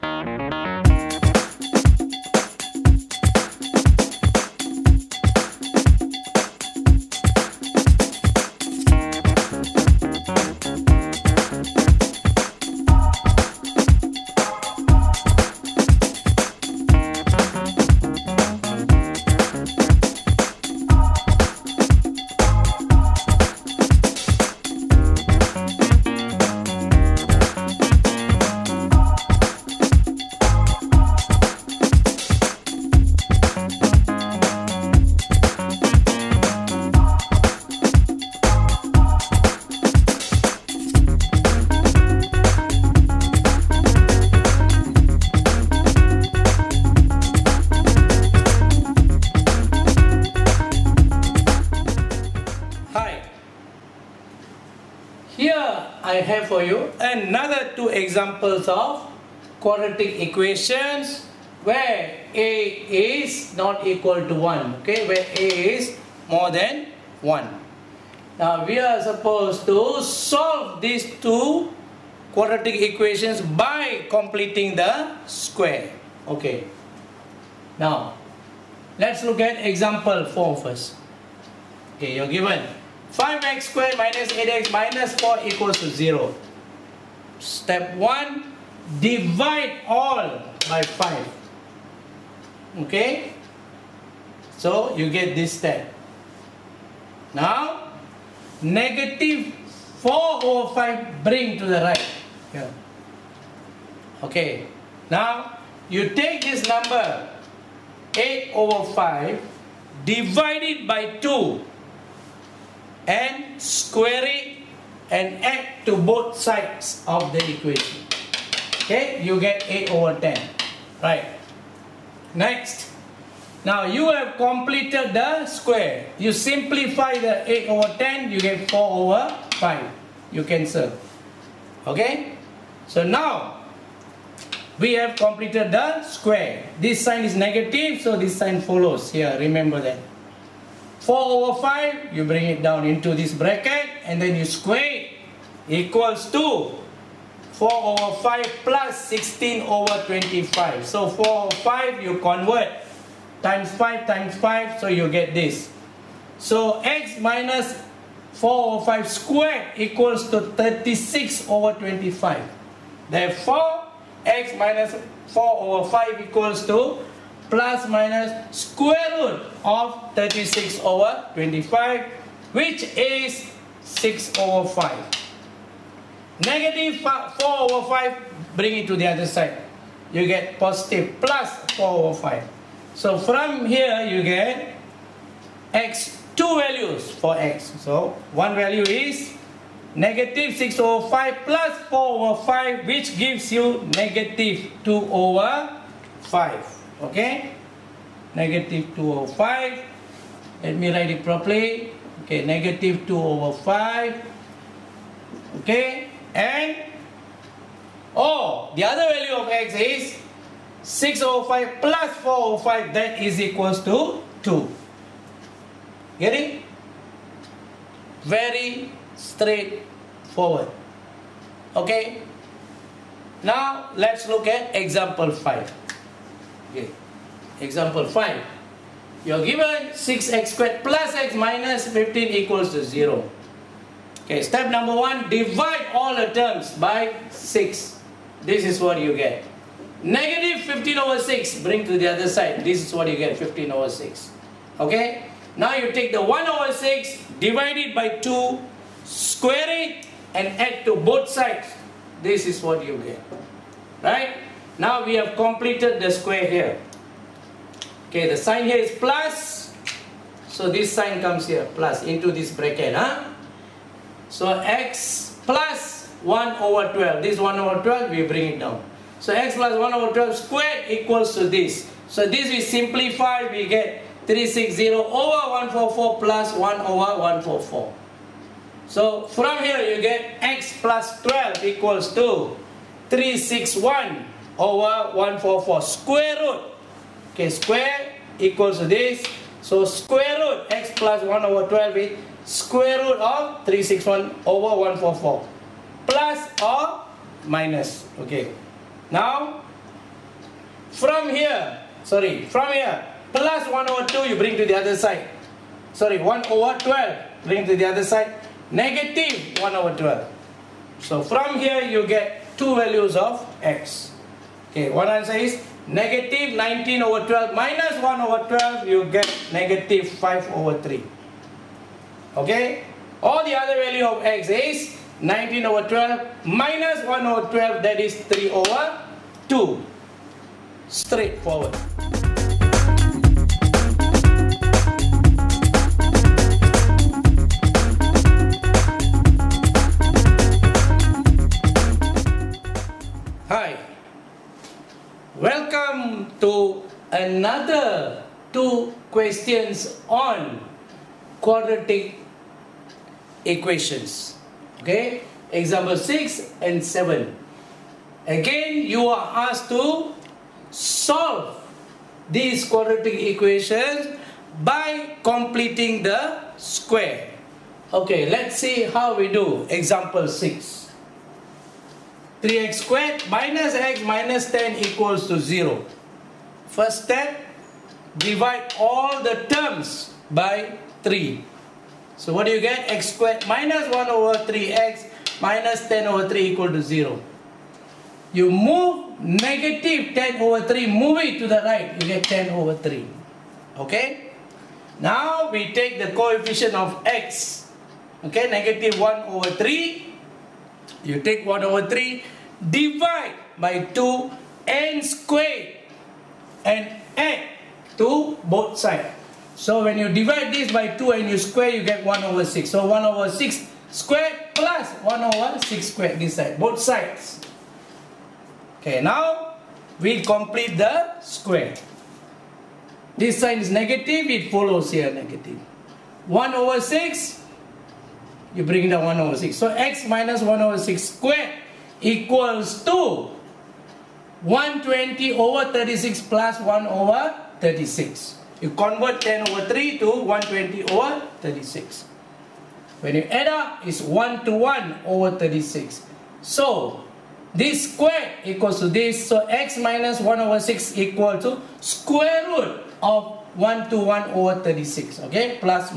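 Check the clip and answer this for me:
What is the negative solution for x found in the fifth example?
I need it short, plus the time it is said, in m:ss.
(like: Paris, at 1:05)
-5/3, at 5:19.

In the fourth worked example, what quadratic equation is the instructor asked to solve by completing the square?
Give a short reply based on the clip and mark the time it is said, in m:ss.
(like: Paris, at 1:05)
5x^2 - 8x - 4 = 0, at 1:23.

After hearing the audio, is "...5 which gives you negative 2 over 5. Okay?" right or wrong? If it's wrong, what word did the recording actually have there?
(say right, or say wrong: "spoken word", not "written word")
right.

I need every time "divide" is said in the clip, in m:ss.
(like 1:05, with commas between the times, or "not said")
1:28, 1:50, 3:55, 4:07, 6:18, 6:42, 6:50.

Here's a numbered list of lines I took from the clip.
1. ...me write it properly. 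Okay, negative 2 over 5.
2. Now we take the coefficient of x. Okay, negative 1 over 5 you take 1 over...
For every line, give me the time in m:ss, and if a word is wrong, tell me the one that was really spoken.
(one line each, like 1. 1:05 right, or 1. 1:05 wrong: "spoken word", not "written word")
1. 3:20 right
2. 6:34 wrong: "3", not "5".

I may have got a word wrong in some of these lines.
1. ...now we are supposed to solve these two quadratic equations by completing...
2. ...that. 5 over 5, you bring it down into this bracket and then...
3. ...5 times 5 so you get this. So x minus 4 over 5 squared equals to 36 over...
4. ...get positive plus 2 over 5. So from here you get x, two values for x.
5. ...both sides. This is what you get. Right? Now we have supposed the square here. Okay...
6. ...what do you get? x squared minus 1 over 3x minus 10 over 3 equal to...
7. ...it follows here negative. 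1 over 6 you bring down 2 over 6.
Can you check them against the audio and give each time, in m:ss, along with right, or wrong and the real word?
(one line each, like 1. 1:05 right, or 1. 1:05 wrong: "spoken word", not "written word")
1. 1:08 right
2. 2:19 wrong: "4", not "5"
3. 2:33 right
4. 3:00 wrong: "4", not "2"
5. 4:10 wrong: "completed", not "supposed"
6. 6:22 right
7. 7:04 wrong: "1", not "2".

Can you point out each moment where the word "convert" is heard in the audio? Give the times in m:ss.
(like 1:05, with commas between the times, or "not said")
2:32, 7:18.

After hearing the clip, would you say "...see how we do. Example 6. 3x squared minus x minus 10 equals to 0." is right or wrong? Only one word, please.
right.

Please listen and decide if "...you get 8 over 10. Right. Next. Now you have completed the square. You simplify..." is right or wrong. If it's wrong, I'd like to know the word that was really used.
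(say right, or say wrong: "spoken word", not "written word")
right.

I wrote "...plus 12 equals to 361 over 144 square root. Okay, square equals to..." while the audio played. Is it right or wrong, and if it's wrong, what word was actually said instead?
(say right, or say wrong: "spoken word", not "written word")
right.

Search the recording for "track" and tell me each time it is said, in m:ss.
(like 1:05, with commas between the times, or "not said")
not said.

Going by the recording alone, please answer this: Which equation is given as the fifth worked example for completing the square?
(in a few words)
6x^2 + x - 15 = 0.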